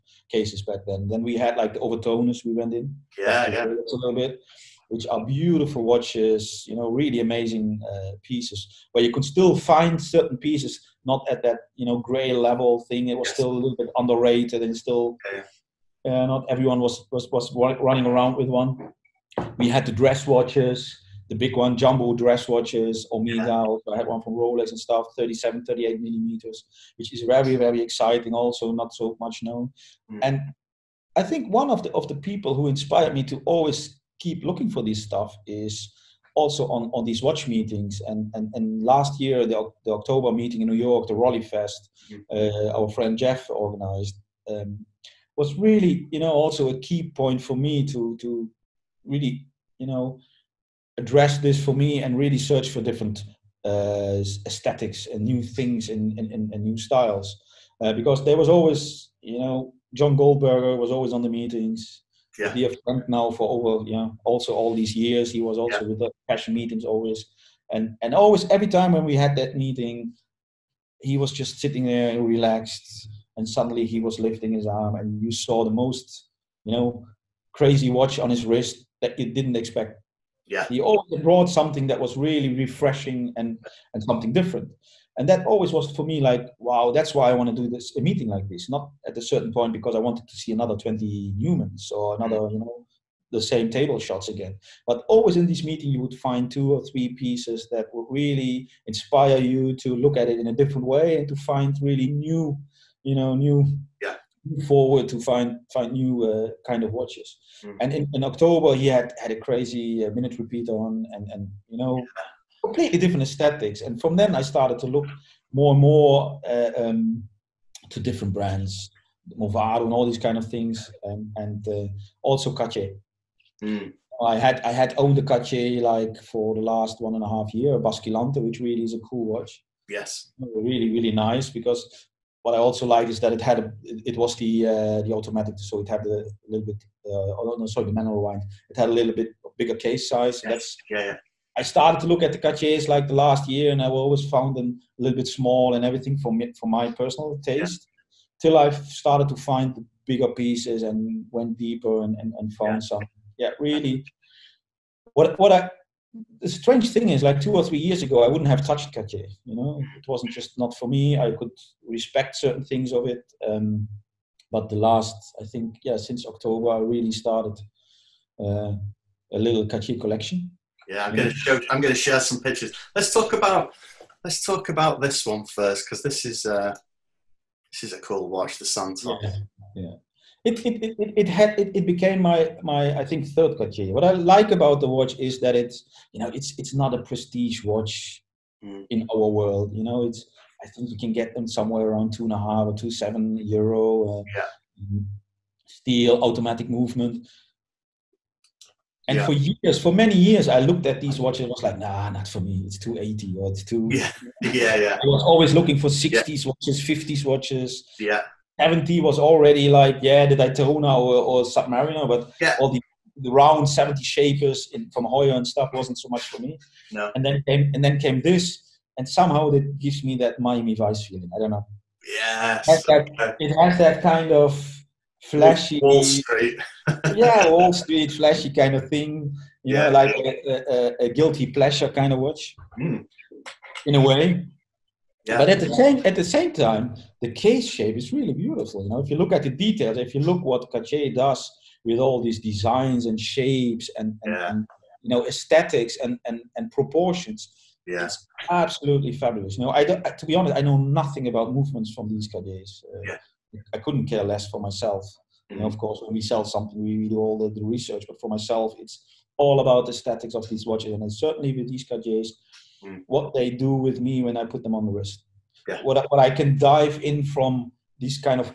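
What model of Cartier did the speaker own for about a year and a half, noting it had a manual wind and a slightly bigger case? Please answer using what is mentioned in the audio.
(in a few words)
Basculante.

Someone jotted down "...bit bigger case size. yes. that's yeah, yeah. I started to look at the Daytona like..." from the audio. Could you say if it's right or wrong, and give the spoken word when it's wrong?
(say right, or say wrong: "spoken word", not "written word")
wrong: "Cartiers", not "Daytona".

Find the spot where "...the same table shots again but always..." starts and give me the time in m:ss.
1:33.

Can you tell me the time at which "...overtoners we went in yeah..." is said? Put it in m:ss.
0:01.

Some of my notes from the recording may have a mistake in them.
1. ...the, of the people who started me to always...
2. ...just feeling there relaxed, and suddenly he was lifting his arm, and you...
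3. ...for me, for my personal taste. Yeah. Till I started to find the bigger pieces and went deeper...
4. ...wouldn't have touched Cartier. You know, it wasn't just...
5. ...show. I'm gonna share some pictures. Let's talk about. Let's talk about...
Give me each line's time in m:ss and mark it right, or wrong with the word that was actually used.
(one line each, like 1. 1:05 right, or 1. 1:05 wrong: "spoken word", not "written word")
1. 0:31 wrong: "inspired", not "started"
2. 1:11 wrong: "sitting", not "feeling"
3. 2:26 right
4. 2:38 right
5. 2:51 right.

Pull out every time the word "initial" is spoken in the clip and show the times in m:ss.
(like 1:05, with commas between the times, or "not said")
not said.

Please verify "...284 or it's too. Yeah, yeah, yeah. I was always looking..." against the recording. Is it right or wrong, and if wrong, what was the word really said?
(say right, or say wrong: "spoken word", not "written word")
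wrong: "280", not "284".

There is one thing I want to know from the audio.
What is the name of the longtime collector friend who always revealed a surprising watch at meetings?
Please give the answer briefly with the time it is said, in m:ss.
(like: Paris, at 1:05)
John Goldberger, at 0:59.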